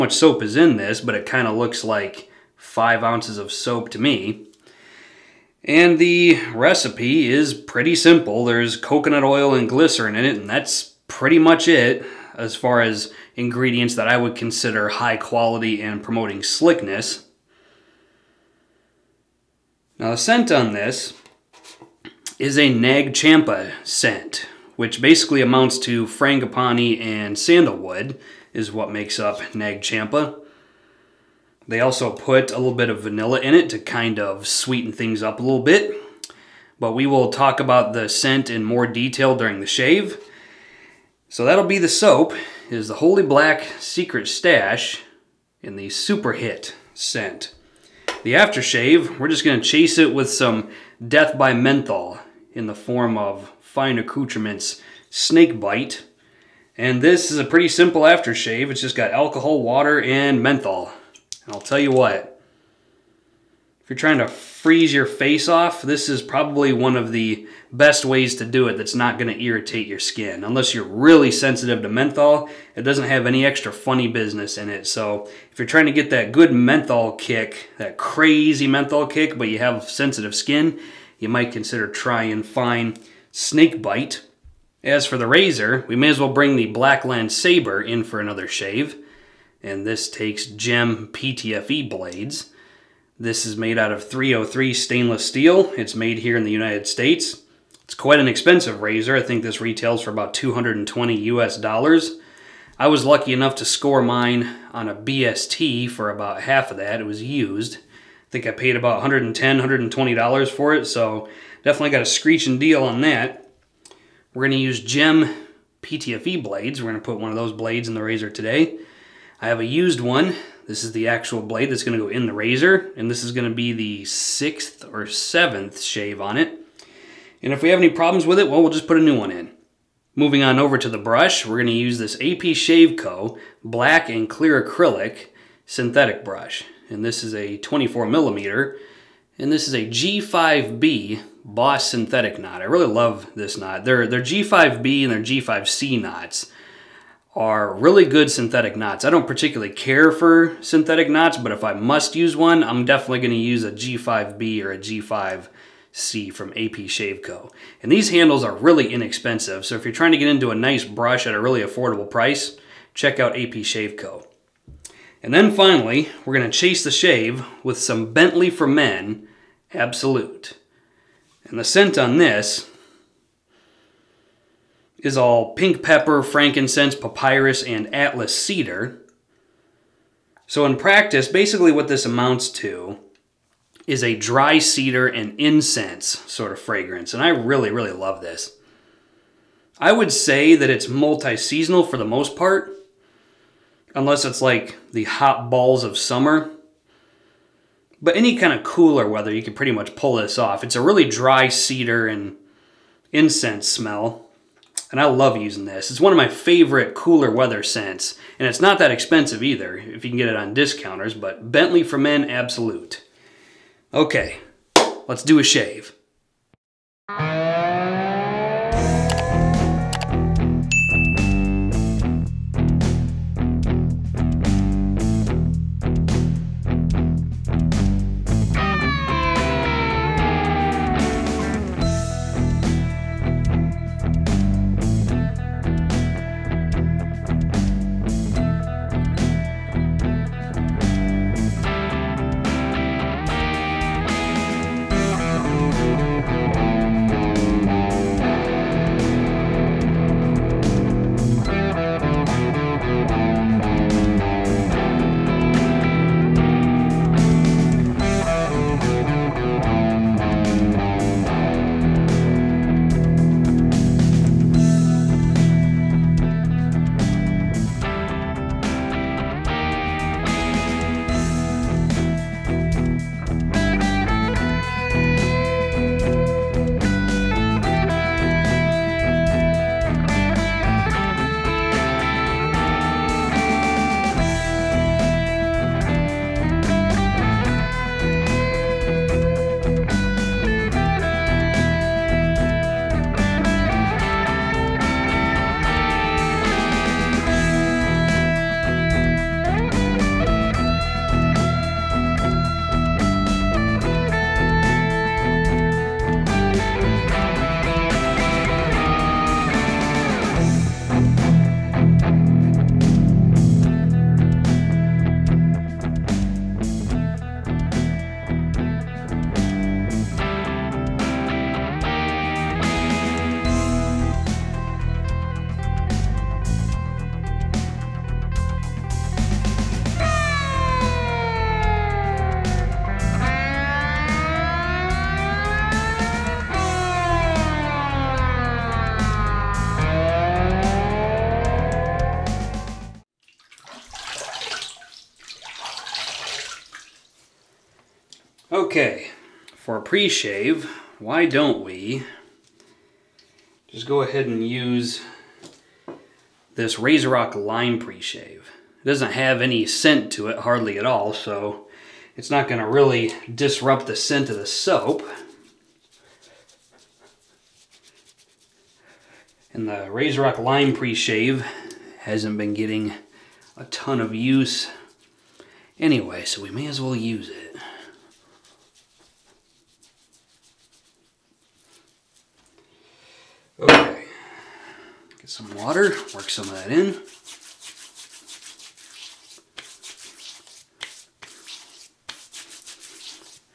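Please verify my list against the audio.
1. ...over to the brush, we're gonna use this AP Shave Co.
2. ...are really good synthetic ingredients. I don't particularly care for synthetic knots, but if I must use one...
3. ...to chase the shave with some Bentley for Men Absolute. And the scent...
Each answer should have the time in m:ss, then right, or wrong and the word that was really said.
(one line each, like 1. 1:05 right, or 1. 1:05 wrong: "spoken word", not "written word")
1. 2:10 right
2. 2:27 wrong: "knots", not "ingredients"
3. 2:46 right.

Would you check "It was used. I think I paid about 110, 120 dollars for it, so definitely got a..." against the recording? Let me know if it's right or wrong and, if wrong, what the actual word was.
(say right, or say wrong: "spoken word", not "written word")
right.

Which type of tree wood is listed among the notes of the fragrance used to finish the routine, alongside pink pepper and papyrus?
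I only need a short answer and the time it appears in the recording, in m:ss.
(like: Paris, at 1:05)
Atlas cedar, at 2:57.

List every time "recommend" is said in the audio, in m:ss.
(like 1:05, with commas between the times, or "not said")
not said.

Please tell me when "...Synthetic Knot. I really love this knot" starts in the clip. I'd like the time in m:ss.
2:21.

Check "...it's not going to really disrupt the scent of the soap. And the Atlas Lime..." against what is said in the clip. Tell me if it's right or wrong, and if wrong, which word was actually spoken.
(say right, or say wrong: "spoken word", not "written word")
wrong: "RazoRock", not "Atlas".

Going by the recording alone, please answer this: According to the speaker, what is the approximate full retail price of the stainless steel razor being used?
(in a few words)
$220.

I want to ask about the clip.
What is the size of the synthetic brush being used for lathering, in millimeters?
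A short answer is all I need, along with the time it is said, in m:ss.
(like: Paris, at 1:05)
24 millimeters, at 2:17.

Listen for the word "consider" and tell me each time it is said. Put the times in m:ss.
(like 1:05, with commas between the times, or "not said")
0:14, 1:21.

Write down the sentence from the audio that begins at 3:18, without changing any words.
But any kind of cooler weather, you can pretty much pull this off.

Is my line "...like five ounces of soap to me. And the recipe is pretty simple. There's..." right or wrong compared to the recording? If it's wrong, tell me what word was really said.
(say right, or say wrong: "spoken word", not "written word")
right.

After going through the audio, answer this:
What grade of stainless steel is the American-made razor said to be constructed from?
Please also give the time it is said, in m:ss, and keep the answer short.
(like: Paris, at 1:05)
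303, at 1:34.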